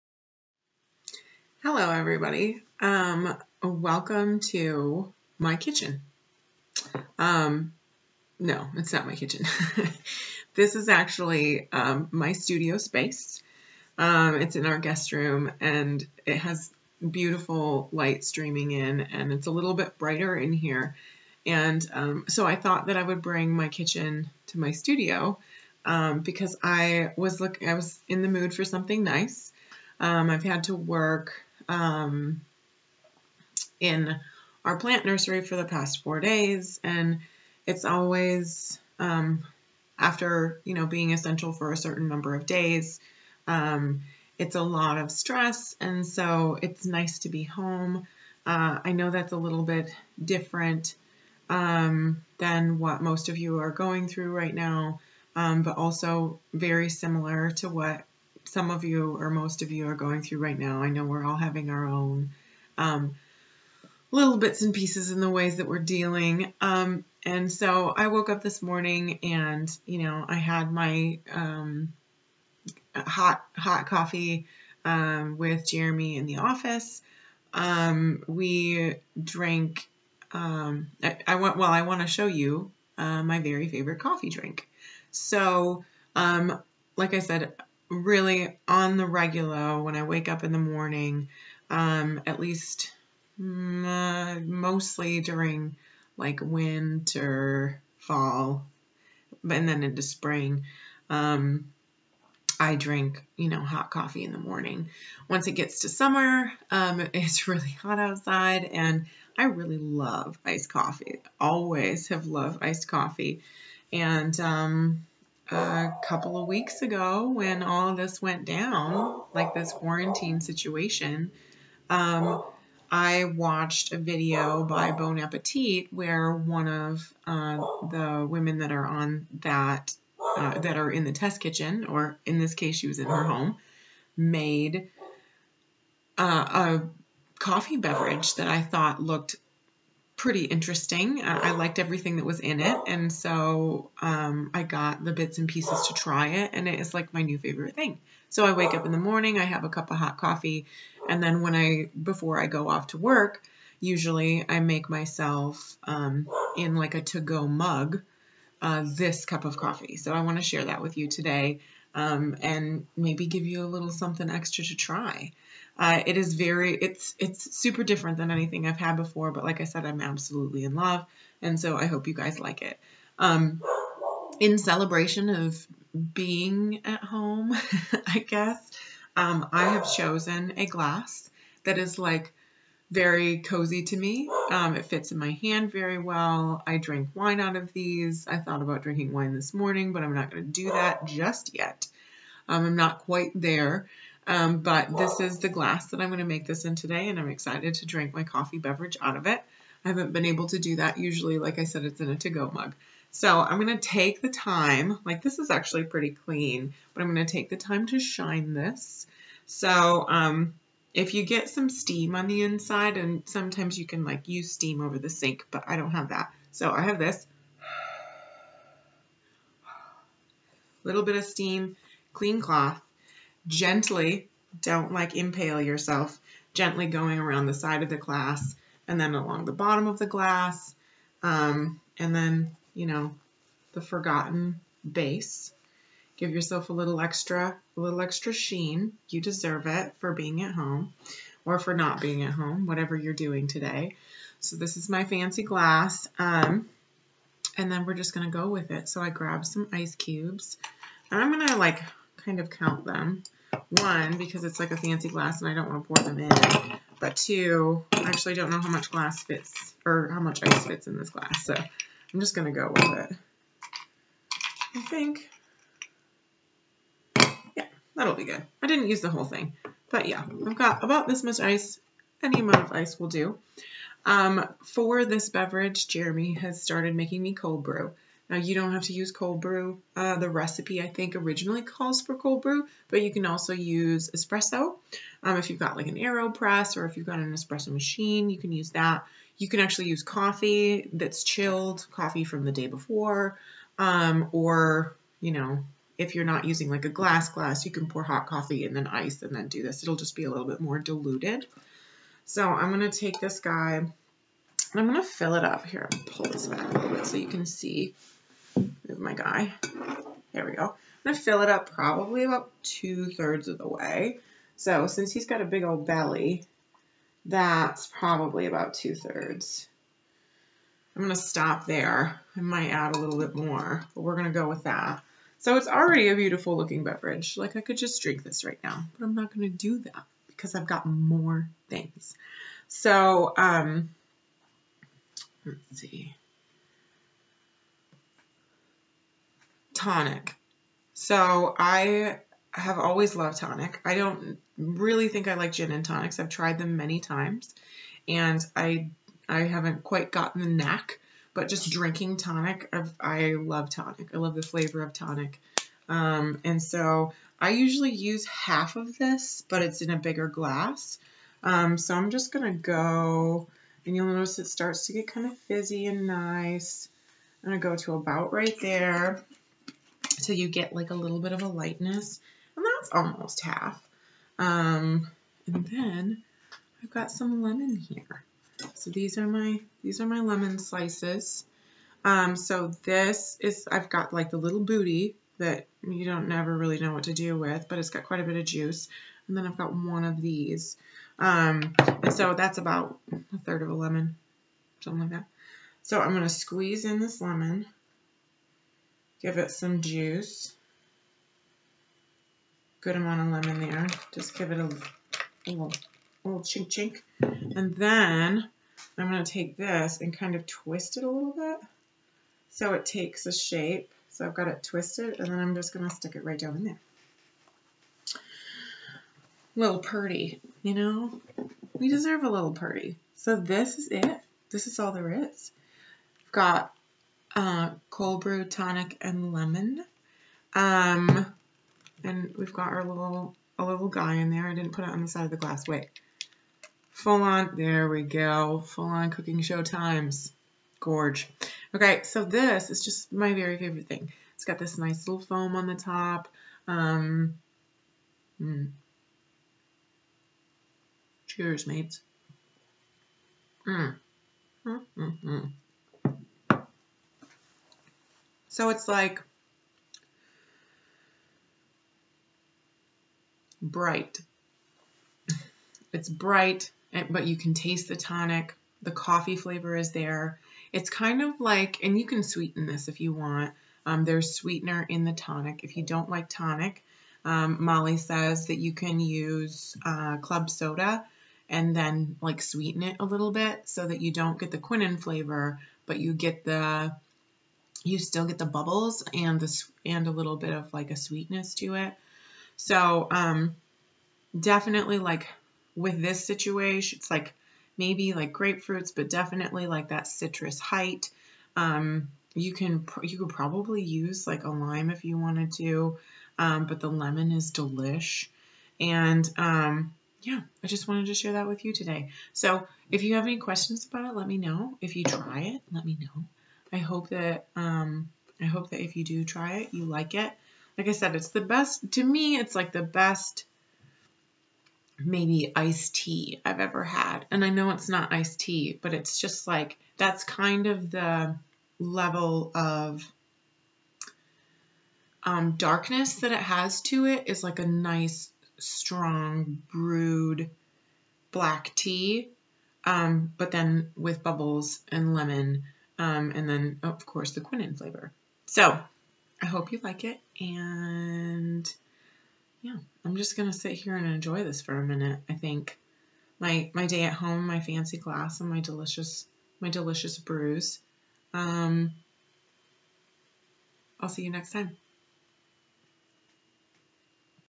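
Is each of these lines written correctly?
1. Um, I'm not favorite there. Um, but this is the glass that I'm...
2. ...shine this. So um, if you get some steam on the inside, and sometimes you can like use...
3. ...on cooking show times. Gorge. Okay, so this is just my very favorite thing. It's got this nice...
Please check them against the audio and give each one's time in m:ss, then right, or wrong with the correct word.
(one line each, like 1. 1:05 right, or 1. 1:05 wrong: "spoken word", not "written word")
1. 3:12 wrong: "quite", not "favorite"
2. 3:27 right
3. 7:18 right.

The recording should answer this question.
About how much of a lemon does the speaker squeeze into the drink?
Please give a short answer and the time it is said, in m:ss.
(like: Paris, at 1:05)
a third, at 6:33.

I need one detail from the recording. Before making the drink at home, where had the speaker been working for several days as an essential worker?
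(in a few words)
plant nursery.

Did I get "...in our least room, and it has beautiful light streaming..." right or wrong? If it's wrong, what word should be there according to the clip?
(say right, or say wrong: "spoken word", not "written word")
wrong: "guest", not "least".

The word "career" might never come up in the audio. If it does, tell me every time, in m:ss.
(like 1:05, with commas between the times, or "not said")
not said.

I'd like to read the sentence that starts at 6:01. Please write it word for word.
Um, so I'm just going to go, and you'll notice it starts to get kind of fizzy and nice.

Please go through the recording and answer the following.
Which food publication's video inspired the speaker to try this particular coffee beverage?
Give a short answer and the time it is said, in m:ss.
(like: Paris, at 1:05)
Bon Appetit, at 2:04.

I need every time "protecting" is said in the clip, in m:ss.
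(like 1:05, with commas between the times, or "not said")
not said.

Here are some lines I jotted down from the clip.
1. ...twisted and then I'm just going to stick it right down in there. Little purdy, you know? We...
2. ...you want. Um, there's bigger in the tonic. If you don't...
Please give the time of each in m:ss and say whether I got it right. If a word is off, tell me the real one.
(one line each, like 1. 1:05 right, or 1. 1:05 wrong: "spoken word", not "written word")
1. 6:54 right
2. 7:52 wrong: "sweetener", not "bigger".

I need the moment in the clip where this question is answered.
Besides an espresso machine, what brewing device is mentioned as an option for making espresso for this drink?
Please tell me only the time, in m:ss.
4:45.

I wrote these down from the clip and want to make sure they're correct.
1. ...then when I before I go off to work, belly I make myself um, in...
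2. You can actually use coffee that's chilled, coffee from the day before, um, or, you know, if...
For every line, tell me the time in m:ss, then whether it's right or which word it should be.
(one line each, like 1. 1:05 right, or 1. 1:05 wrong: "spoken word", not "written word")
1. 2:31 wrong: "usually", not "belly"
2. 4:49 right.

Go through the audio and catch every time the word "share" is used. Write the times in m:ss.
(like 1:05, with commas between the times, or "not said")
2:40, 8:31.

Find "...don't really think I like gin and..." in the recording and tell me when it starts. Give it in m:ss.
5:43.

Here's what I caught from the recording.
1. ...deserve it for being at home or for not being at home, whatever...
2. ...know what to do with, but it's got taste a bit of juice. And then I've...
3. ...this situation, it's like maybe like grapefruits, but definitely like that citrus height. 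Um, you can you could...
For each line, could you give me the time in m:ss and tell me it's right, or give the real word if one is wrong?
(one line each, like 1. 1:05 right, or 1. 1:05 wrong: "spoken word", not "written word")
1. 3:59 right
2. 6:26 wrong: "quite", not "taste"
3. 8:16 right.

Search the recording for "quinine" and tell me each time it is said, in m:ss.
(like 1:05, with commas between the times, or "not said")
8:04, 9:07.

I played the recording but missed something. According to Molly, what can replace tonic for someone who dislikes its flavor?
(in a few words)
club soda.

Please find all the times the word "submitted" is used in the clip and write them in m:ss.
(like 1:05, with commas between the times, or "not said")
not said.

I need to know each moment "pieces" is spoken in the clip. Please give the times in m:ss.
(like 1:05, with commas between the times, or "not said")
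1:04, 2:25.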